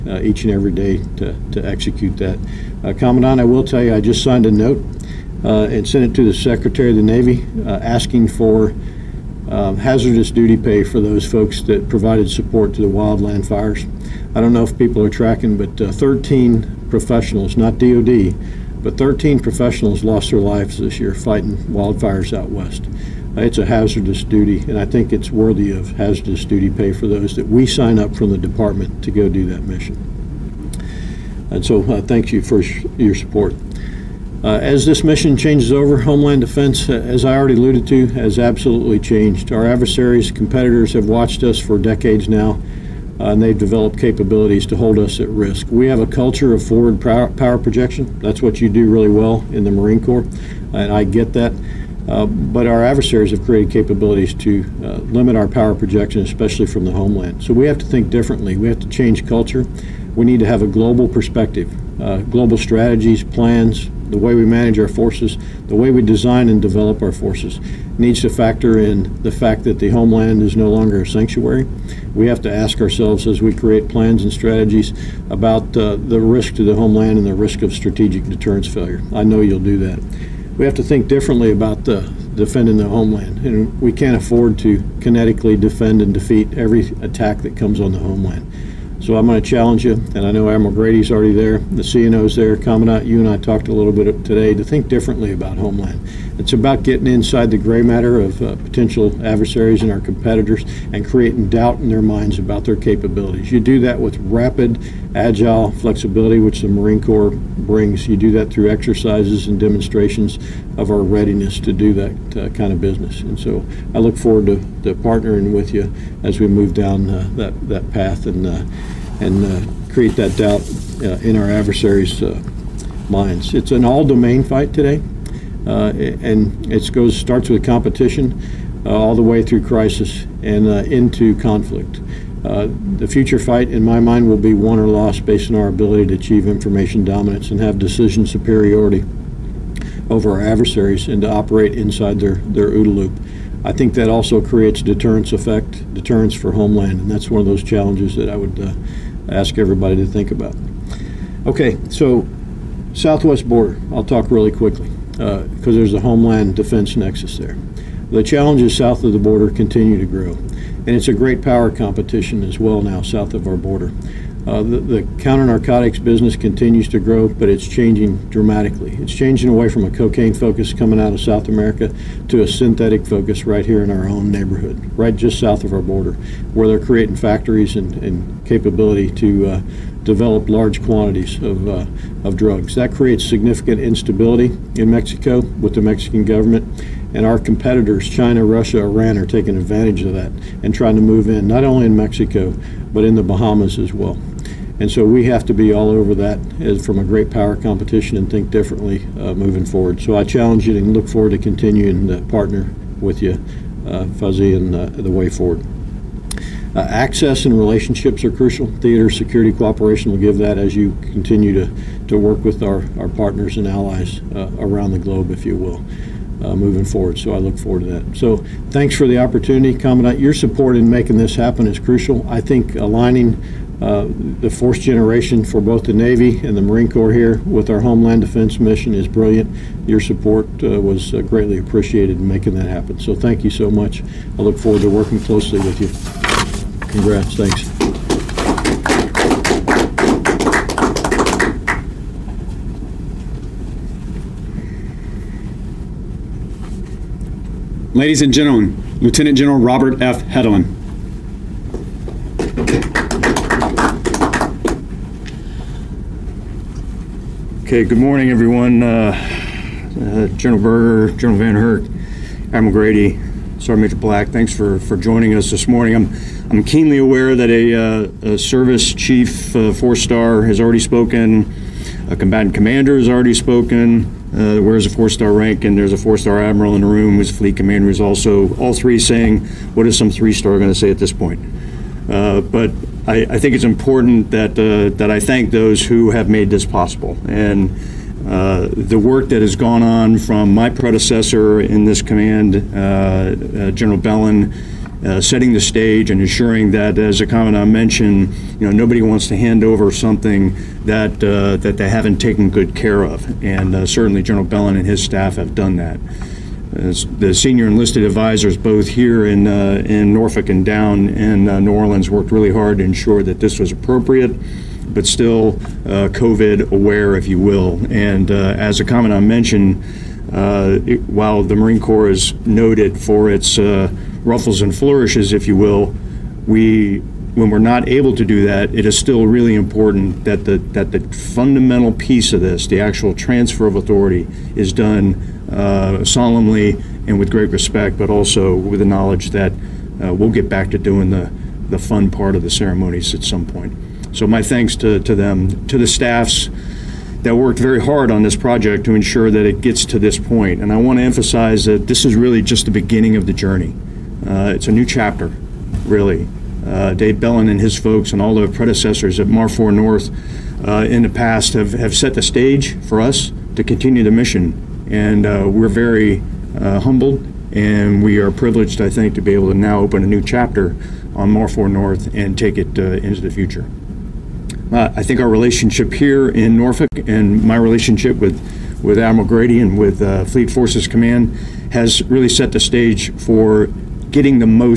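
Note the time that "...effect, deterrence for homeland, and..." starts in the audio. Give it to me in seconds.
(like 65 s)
145 s.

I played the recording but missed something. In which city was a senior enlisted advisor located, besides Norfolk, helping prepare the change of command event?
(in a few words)
New Orleans.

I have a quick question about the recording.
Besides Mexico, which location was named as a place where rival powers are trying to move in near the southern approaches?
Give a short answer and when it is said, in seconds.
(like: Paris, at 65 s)
The Bahamas, at 193 s.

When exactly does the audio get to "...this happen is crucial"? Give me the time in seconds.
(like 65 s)
221 s.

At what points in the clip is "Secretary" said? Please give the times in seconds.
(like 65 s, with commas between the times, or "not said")
6 s.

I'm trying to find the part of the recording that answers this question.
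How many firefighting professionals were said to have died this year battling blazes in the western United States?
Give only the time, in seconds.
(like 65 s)
18 s.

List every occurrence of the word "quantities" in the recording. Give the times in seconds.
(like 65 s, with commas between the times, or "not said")
180 s.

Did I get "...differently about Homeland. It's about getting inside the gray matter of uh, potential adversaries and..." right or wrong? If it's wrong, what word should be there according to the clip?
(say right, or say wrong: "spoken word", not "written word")
right.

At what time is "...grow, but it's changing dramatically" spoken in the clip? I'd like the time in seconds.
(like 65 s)
166 s.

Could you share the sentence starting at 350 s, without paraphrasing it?
And I want to emphasize that this is really just the beginning of the journey.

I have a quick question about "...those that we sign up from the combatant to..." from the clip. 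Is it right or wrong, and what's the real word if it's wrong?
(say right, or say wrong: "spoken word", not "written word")
wrong: "department", not "combatant".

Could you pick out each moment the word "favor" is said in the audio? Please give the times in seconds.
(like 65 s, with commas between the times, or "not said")
not said.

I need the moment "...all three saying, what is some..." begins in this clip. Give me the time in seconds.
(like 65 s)
278 s.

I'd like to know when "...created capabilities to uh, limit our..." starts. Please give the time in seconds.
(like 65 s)
53 s.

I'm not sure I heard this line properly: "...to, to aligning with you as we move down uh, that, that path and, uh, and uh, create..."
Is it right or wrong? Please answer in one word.
wrong.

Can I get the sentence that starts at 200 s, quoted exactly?
So I challenge you and look forward to continuing to partner with you, uh, Fuzzy, and uh, the way forward.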